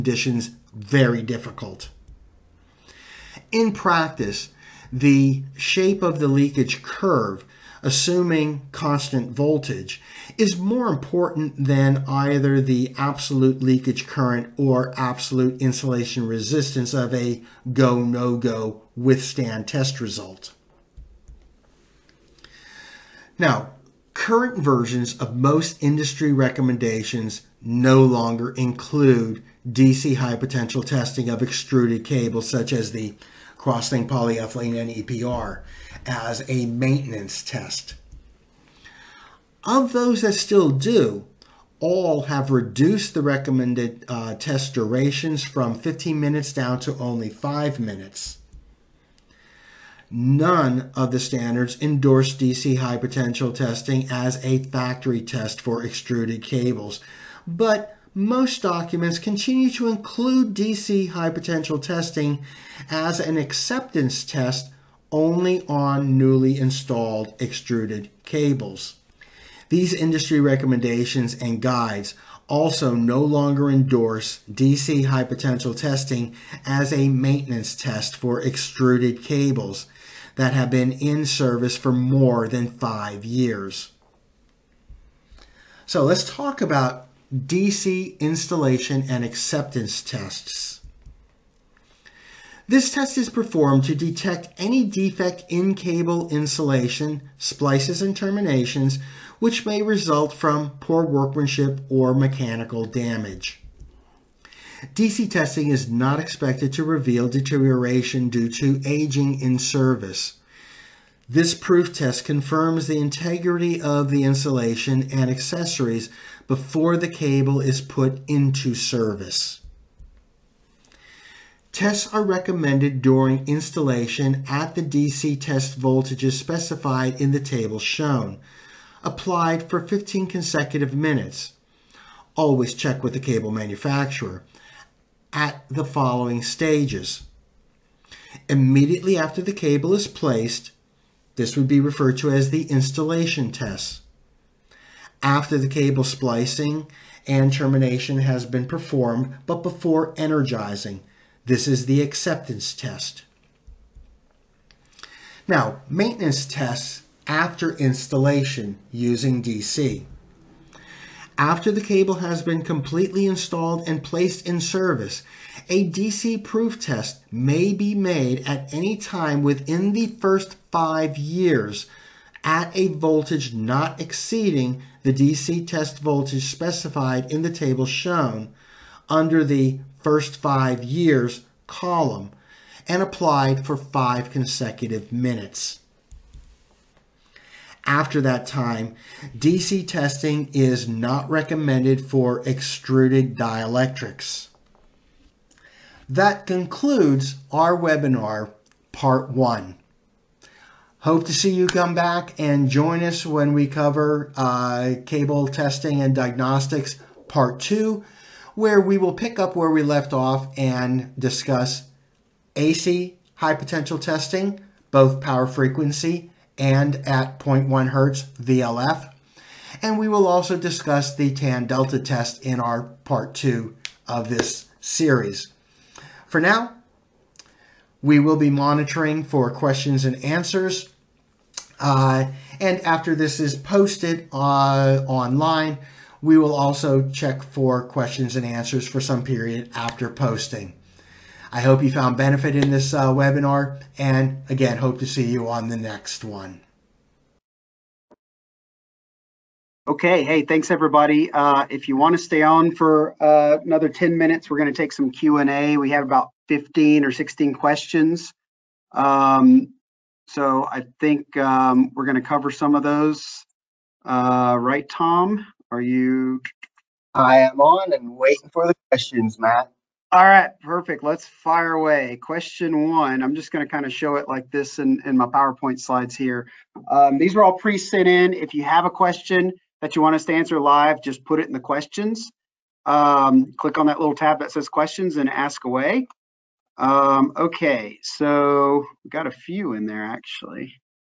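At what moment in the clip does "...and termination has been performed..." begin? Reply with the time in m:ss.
2:27.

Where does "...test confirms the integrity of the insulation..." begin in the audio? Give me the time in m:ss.
1:51.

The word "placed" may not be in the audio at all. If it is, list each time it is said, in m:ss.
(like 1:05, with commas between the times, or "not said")
2:20, 2:44.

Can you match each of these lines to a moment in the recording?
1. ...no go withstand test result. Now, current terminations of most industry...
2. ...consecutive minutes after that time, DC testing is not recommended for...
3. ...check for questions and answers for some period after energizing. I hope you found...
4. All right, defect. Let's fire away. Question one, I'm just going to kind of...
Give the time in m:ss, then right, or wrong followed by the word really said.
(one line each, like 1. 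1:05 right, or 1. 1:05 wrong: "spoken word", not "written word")
1. 0:18 wrong: "versions", not "terminations"
2. 3:04 right
3. 3:57 wrong: "posting", not "energizing"
4. 4:30 wrong: "perfect", not "defect".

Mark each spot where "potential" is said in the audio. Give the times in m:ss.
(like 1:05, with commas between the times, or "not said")
0:30, 0:52, 1:01, 1:15, 3:33.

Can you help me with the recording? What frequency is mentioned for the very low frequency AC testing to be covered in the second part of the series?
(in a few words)
0.1 hertz.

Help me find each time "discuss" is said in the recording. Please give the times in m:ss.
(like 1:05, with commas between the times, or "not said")
3:31, 3:40.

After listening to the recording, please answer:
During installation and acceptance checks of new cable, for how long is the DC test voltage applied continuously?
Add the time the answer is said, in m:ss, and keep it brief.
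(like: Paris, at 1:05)
15 consecutive minutes, at 2:09.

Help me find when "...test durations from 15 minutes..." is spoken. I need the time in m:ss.
0:44.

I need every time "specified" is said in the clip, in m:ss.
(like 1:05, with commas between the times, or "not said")
2:06, 2:56.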